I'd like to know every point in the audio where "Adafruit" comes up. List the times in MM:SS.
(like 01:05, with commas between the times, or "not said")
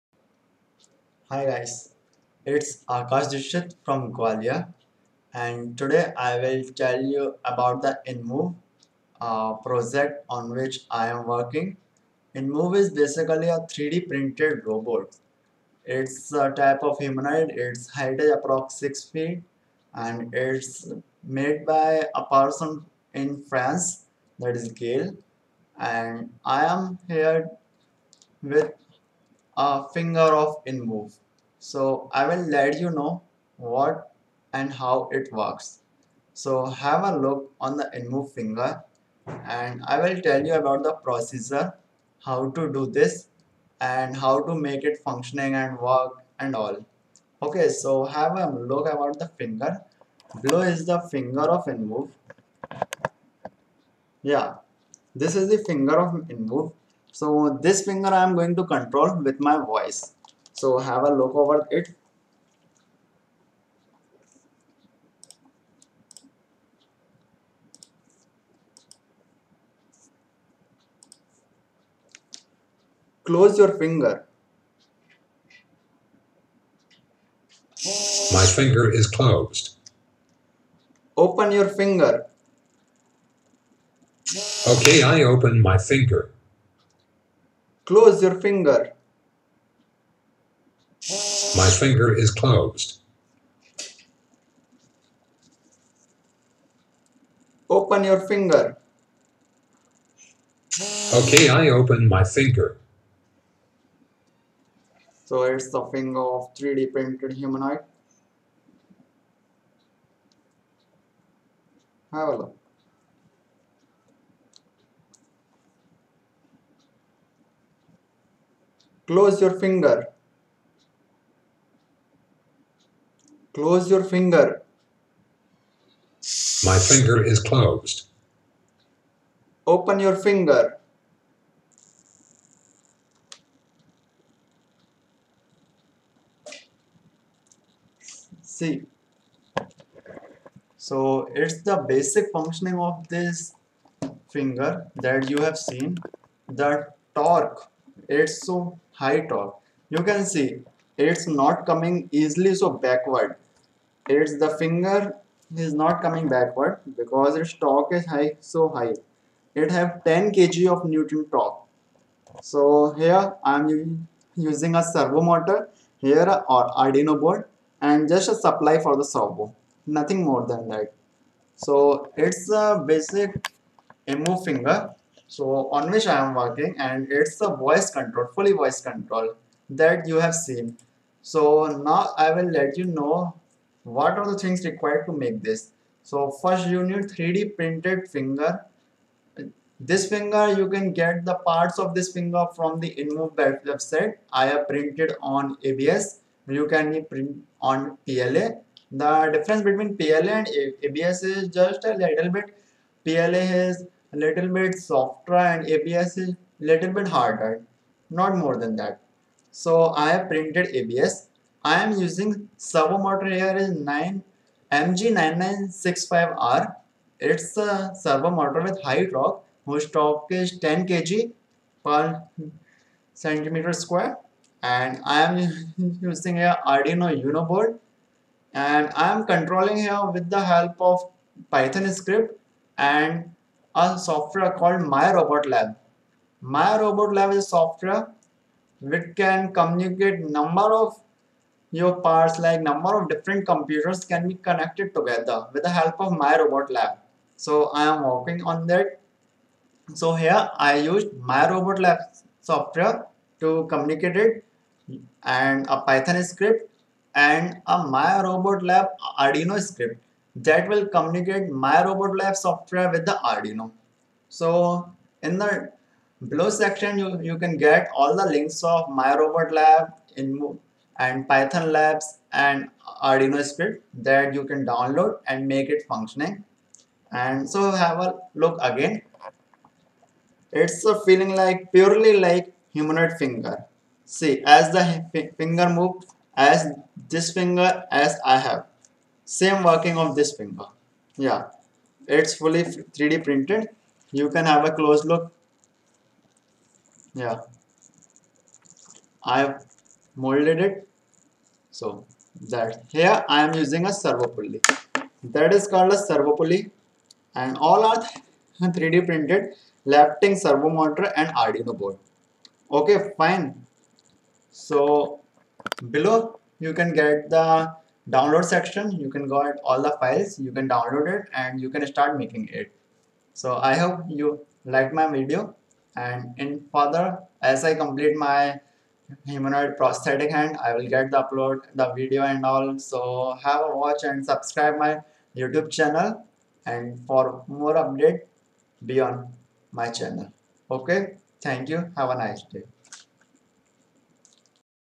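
not said.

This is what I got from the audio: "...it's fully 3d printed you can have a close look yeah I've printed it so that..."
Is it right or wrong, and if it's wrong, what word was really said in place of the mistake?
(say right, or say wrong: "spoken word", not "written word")
wrong: "molded", not "printed".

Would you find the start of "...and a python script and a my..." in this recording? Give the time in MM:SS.
04:15.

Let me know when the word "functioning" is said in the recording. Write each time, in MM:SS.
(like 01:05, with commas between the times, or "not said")
00:45, 02:22, 04:35.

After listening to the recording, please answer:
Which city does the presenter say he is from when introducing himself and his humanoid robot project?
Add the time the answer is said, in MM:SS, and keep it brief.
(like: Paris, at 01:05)
Gwalior, at 00:04.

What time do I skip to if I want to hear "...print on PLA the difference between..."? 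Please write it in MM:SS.
03:17.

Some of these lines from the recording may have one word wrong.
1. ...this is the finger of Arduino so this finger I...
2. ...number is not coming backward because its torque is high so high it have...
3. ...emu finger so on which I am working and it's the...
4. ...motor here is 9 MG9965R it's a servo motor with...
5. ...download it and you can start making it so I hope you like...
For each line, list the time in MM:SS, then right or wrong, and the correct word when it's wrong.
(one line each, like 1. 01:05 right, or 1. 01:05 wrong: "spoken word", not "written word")
1. 00:55 wrong: "InMoov", not "Arduino"
2. 02:34 wrong: "finger", not "number"
3. 02:54 right
4. 03:32 right
5. 05:20 right.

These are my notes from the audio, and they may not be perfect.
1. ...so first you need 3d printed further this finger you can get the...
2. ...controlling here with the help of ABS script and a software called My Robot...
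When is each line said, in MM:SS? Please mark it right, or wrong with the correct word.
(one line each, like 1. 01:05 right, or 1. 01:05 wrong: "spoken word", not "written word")
1. 03:06 wrong: "finger", not "further"
2. 03:49 wrong: "Python", not "ABS".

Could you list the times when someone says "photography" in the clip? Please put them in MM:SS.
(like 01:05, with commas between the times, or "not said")
not said.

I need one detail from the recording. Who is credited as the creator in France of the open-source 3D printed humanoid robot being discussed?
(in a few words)
Gael.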